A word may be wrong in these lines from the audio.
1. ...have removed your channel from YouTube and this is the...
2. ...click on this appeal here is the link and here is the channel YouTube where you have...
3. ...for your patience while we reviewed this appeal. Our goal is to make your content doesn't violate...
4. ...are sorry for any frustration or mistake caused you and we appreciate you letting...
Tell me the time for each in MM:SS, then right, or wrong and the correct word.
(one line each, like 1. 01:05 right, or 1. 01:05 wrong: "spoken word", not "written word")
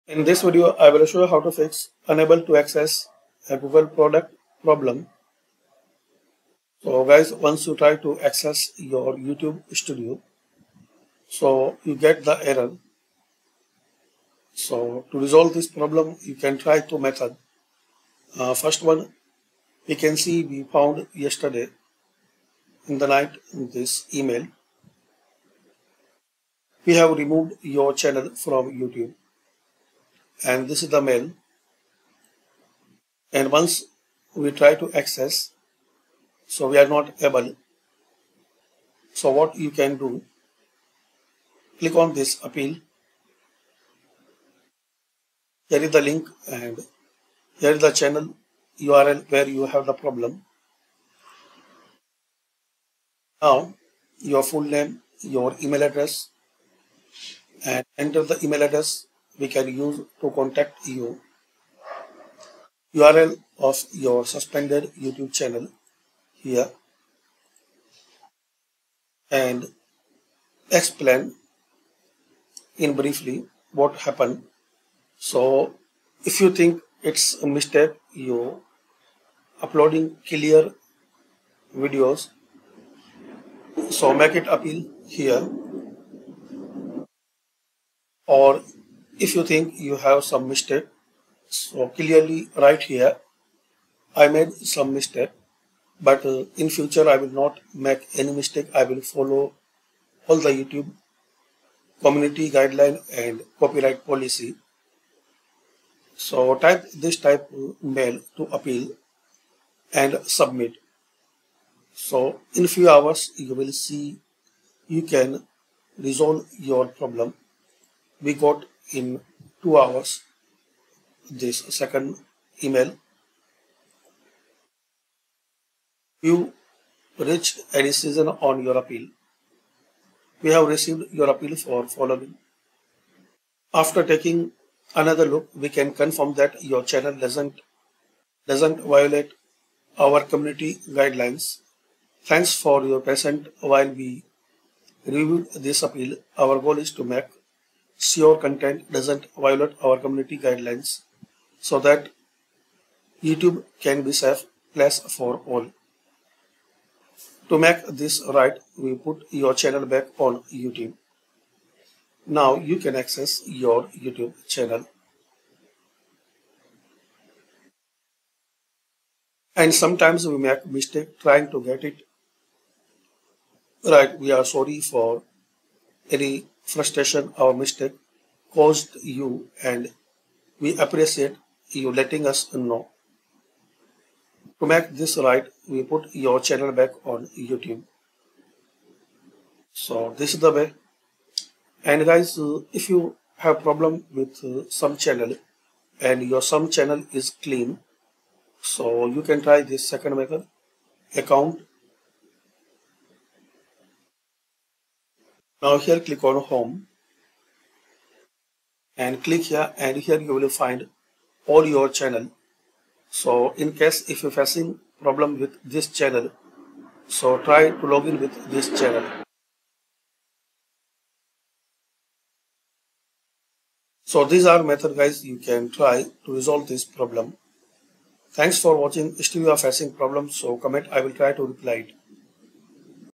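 1. 00:26 right
2. 00:41 wrong: "URL", not "YouTube"
3. 02:22 right
4. 02:54 right.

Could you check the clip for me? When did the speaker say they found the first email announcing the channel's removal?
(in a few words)
Yesterday in the night.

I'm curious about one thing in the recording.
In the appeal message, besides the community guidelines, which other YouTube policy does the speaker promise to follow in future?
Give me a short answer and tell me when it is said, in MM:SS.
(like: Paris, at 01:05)
Copyright policy, at 01:43.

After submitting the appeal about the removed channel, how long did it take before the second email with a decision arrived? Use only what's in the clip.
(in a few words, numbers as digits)
2 hours.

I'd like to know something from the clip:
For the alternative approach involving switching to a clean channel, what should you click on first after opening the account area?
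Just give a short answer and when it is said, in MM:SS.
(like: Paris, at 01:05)
Home, at 03:26.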